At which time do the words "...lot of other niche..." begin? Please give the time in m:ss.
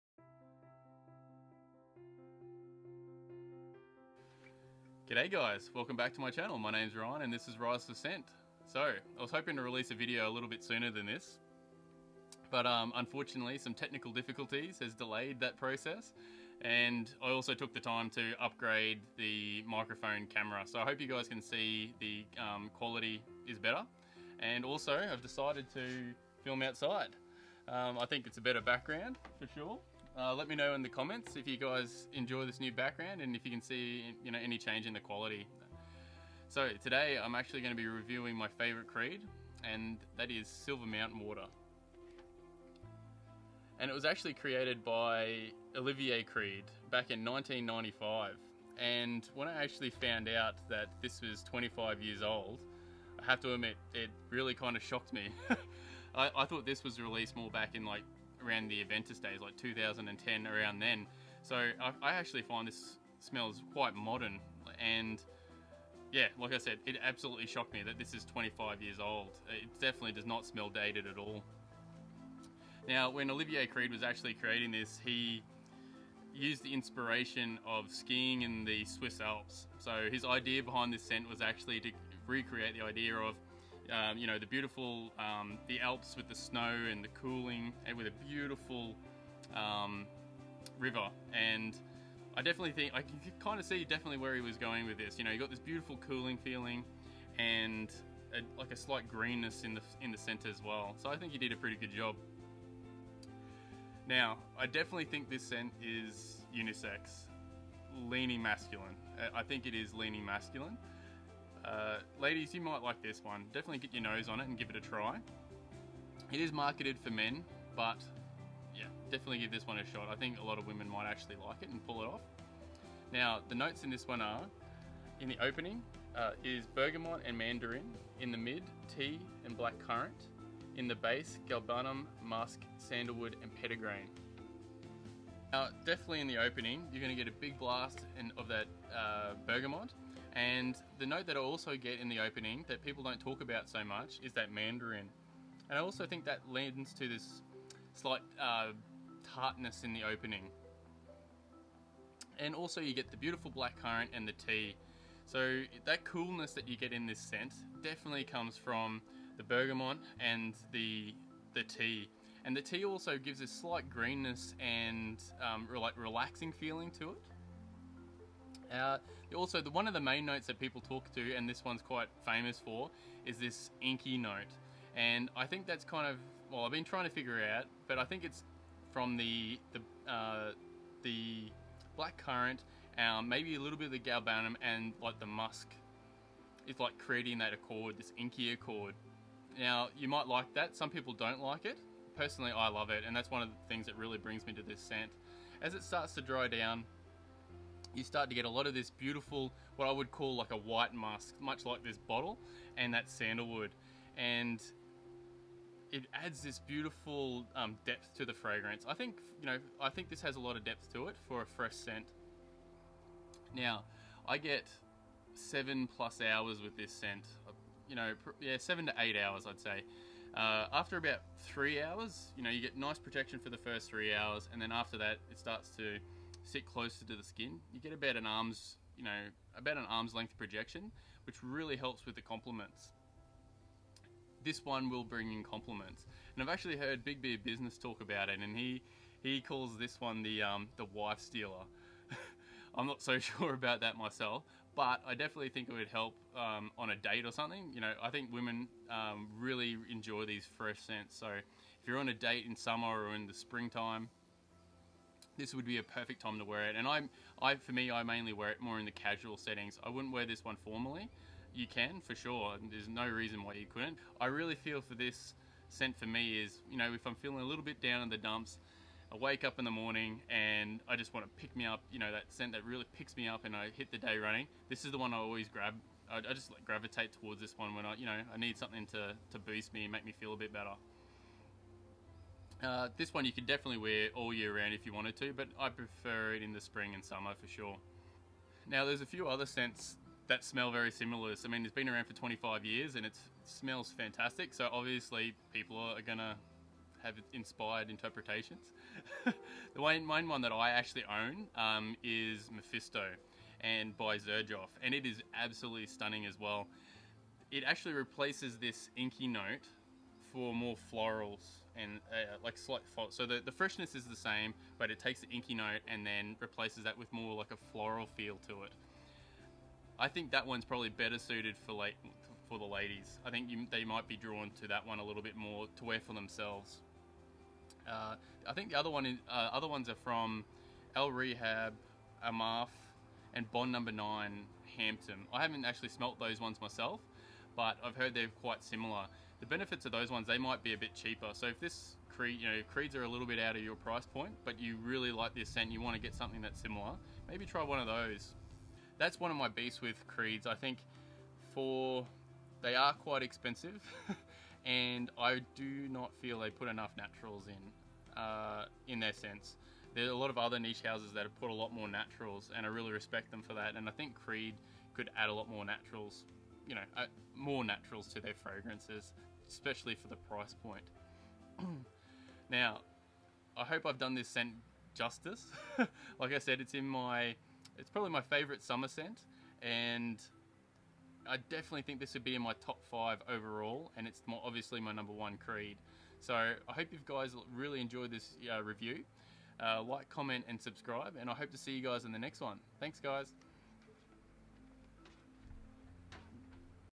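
6:00.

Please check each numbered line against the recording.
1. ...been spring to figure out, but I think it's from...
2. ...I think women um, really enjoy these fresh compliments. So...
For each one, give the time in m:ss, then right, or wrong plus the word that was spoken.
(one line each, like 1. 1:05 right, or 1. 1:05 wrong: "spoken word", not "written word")
1. 2:56 wrong: "trying", not "spring"
2. 4:08 wrong: "scents", not "compliments".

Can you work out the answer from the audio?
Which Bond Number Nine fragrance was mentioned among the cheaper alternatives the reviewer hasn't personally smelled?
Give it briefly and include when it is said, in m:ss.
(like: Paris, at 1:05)
Hampton, at 5:34.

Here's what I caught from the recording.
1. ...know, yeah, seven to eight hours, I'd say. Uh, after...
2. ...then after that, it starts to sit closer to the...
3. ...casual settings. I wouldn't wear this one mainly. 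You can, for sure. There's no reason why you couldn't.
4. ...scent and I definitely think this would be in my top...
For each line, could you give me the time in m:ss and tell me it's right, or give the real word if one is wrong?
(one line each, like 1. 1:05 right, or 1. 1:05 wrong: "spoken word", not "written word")
1. 3:37 right
2. 3:44 right
3. 4:18 wrong: "formally", not "mainly"
4. 6:18 right.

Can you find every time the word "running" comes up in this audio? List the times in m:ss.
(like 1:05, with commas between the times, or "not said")
4:34.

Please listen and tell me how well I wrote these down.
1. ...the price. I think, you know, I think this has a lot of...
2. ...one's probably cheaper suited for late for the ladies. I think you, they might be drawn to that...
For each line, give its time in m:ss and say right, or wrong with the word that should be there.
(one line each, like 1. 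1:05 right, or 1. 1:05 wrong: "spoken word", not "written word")
1. 3:28 wrong: "fragrance", not "price"
2. 5:20 wrong: "better", not "cheaper".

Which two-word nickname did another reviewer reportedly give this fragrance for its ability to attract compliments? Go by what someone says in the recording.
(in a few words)
the wife stealer.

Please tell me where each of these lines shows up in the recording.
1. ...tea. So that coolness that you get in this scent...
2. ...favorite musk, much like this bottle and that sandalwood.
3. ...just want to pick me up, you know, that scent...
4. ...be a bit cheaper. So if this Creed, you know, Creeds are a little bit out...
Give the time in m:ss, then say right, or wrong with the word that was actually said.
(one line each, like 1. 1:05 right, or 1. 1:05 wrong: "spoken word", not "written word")
1. 2:34 right
2. 3:20 wrong: "white", not "favorite"
3. 4:30 right
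4. 5:40 right.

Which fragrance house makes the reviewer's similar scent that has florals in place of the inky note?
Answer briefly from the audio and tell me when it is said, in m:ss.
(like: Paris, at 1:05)
Xerjoff, at 5:04.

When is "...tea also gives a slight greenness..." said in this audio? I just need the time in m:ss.
2:42.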